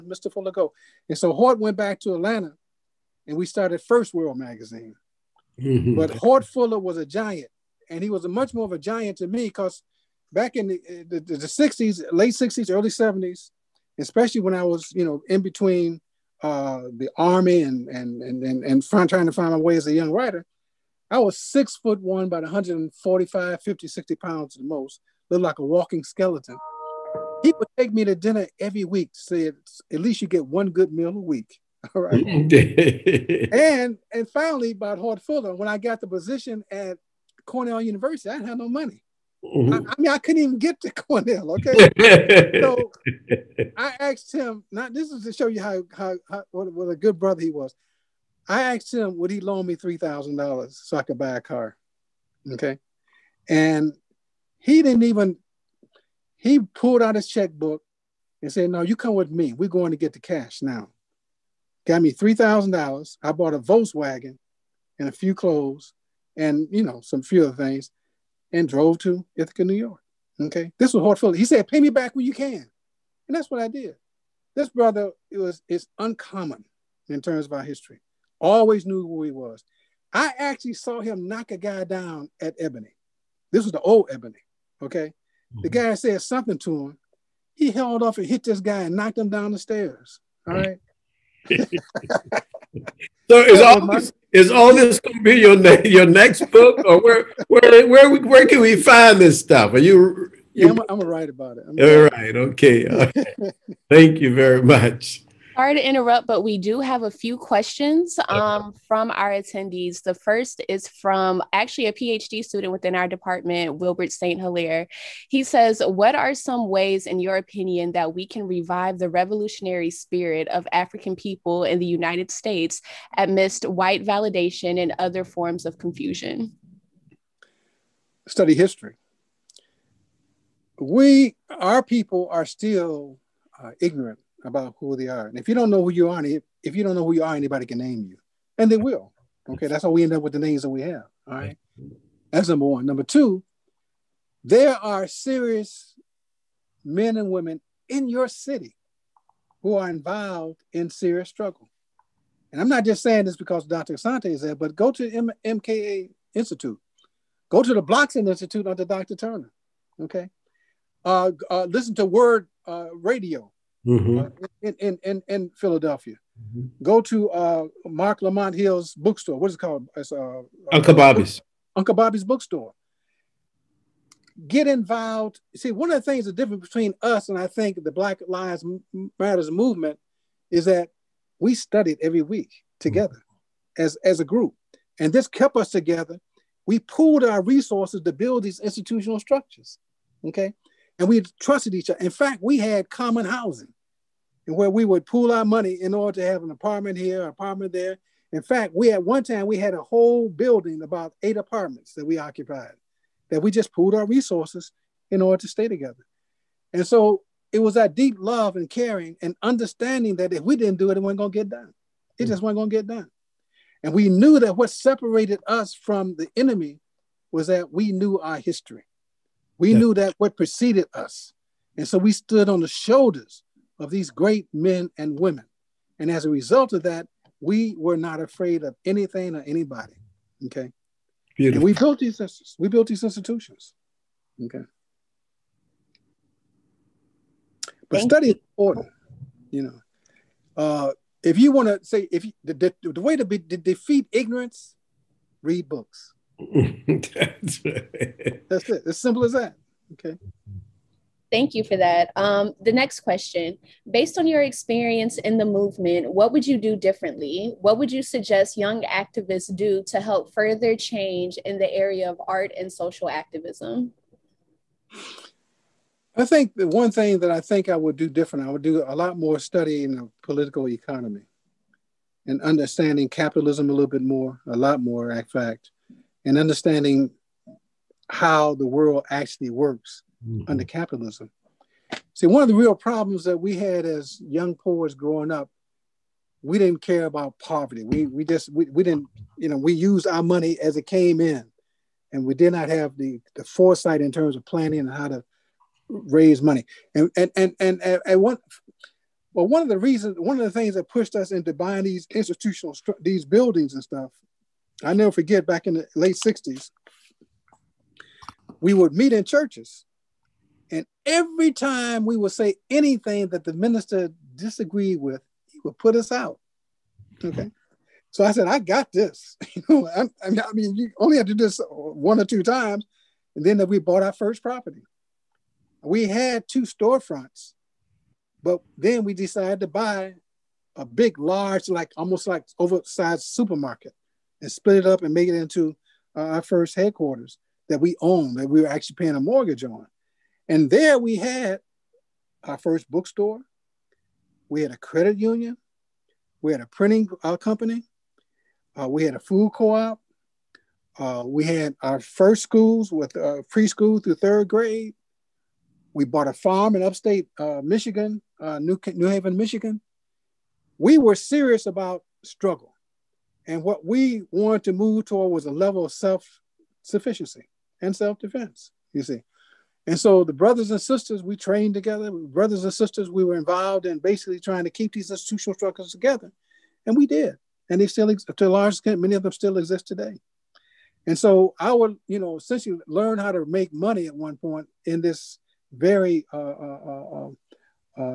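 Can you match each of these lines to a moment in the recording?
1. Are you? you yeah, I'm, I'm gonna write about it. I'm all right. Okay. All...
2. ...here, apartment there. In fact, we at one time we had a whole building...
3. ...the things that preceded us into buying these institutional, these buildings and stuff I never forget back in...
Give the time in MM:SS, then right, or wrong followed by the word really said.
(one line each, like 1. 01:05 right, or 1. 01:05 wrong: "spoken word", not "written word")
1. 01:39 right
2. 03:16 right
3. 05:00 wrong: "pushed", not "preceded".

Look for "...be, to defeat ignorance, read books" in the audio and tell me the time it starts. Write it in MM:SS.
04:03.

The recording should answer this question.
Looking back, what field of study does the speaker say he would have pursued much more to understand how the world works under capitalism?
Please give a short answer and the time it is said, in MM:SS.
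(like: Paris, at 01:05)
political economy, at 04:30.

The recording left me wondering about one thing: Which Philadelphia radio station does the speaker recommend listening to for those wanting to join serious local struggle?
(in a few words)
WURD.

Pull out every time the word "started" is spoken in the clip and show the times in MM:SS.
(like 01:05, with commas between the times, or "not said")
00:03.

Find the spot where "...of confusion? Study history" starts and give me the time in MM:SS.
02:05.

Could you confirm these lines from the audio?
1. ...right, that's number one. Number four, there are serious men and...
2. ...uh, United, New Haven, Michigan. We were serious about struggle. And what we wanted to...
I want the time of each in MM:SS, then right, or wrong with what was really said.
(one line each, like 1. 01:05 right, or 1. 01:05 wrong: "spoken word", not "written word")
1. 02:21 wrong: "two", not "four"
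2. 05:58 wrong: "New", not "United".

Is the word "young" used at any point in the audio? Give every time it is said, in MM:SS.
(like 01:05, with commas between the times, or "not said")
00:19, 04:18, 04:44.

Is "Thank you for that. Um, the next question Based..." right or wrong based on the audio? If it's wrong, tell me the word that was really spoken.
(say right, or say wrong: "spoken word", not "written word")
right.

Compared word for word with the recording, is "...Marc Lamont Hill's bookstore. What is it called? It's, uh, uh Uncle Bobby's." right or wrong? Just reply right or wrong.
right.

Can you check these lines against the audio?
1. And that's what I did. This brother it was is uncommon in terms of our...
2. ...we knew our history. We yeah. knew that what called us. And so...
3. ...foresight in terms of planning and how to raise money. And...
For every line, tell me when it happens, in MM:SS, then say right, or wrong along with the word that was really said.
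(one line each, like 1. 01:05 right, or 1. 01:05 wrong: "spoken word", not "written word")
1. 01:13 right
2. 03:37 wrong: "preceded", not "called"
3. 04:53 right.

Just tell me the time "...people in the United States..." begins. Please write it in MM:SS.
02:01.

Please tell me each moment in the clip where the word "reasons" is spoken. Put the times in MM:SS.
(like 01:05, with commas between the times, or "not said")
04:59.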